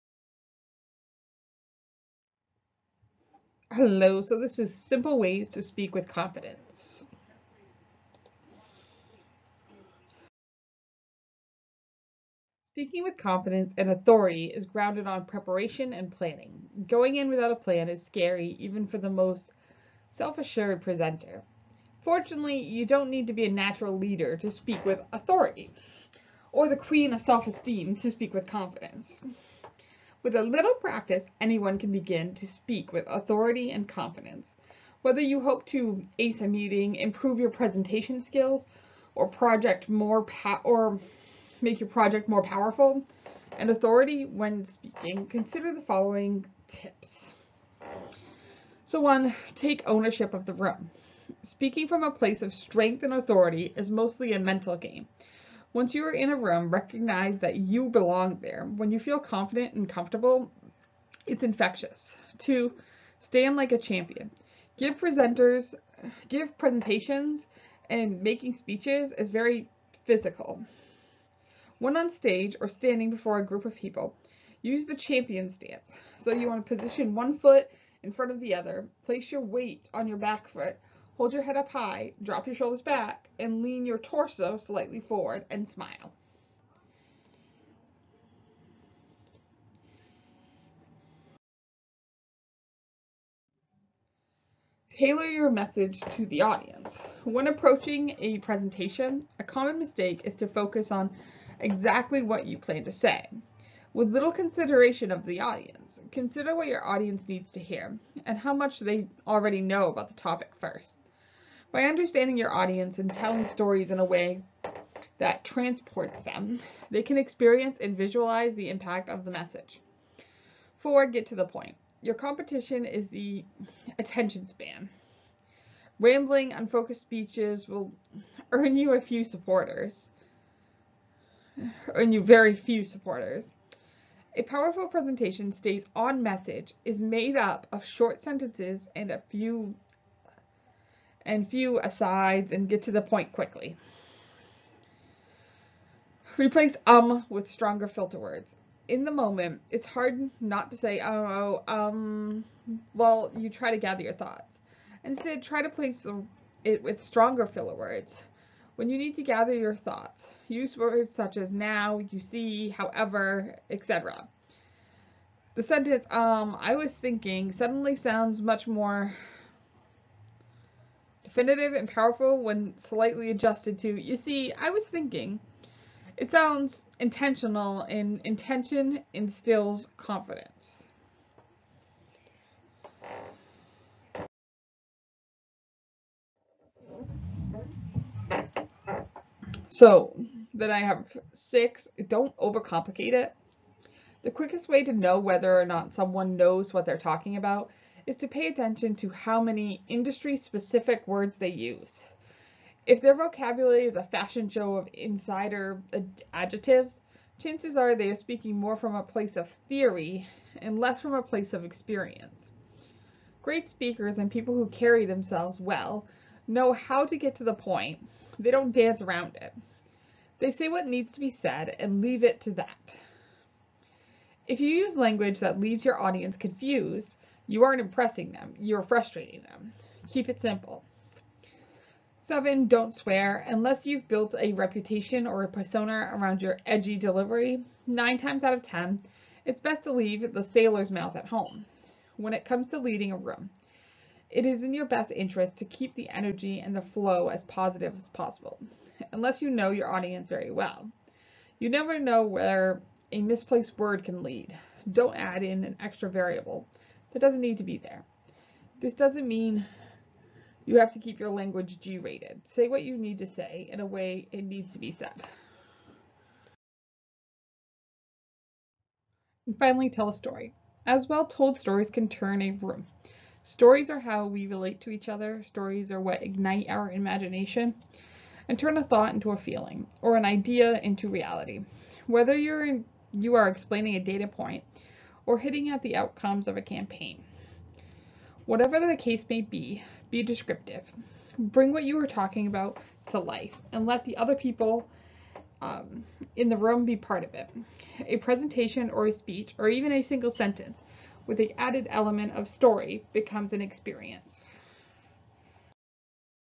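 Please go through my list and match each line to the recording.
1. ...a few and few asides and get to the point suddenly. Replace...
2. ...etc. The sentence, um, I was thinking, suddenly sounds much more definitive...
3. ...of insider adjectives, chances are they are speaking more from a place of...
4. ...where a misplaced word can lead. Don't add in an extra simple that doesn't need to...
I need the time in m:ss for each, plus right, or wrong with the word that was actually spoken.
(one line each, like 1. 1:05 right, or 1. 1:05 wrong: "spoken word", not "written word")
1. 2:19 wrong: "quickly", not "suddenly"
2. 2:43 right
3. 3:24 right
4. 4:12 wrong: "variable", not "simple".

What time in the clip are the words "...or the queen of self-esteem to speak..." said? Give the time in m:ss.
0:26.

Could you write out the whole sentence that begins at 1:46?
Consider what your audience needs to hear and how much they already know about the topic first.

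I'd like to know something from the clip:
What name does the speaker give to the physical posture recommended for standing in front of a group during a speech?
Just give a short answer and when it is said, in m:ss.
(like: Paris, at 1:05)
Champion stance, at 1:14.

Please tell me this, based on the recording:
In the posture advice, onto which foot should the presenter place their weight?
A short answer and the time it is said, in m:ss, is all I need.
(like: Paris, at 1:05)
Back foot, at 1:20.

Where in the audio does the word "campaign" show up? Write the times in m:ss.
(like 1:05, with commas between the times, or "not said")
4:46.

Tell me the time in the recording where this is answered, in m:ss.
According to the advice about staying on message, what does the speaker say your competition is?
2:03.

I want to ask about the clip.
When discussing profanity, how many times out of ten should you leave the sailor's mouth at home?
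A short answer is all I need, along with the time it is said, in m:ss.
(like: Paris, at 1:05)
9, at 3:57.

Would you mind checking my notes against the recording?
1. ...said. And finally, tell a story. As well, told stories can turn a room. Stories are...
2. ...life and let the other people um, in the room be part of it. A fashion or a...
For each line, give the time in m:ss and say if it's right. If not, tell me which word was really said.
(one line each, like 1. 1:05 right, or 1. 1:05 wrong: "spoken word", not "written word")
1. 4:24 right
2. 4:53 wrong: "presentation", not "fashion".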